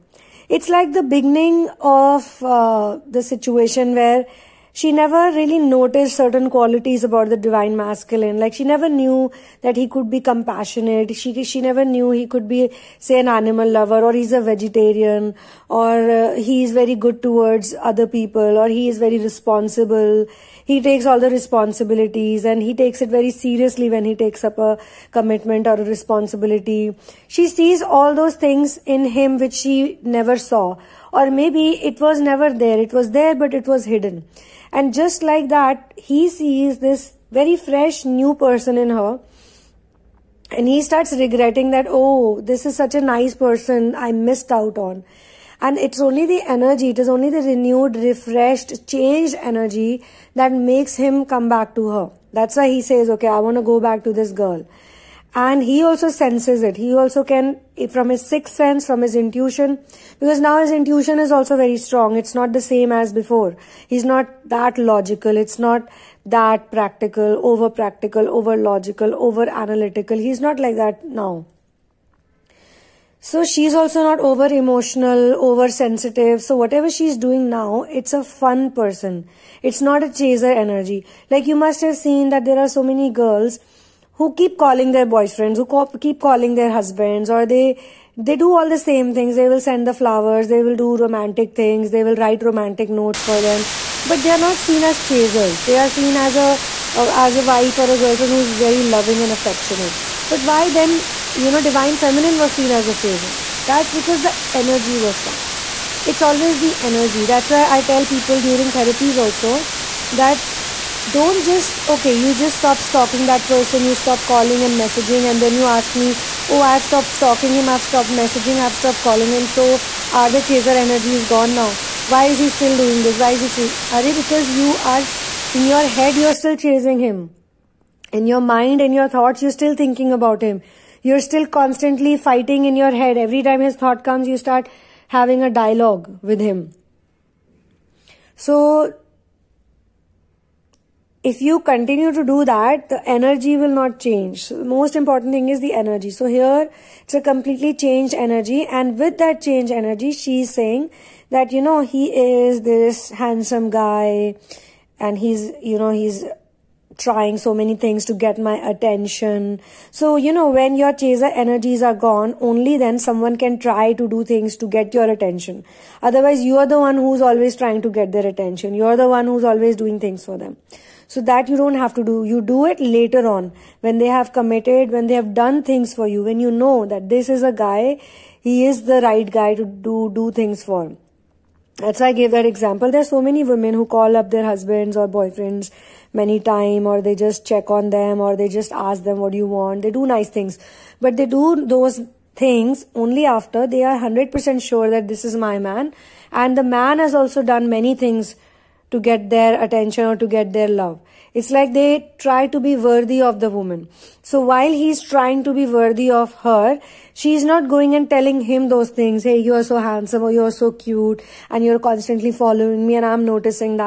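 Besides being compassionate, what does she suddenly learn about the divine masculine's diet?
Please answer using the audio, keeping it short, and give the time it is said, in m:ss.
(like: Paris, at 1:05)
vegetarian, at 0:14.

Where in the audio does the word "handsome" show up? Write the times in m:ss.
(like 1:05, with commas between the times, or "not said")
2:33, 3:29.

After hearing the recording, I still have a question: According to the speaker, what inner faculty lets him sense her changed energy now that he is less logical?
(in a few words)
sixth sense.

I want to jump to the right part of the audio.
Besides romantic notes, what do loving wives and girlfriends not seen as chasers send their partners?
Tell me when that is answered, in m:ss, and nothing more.
1:29.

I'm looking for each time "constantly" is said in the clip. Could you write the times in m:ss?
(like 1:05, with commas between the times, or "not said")
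2:11, 3:31.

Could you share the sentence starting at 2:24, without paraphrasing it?
So the most important thing is the energy.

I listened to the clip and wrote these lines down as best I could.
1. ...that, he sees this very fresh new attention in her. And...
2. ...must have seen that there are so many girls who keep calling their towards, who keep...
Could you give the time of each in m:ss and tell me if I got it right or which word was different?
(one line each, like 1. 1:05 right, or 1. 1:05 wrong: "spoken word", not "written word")
1. 0:35 wrong: "person", not "attention"
2. 1:21 wrong: "boyfriends", not "towards".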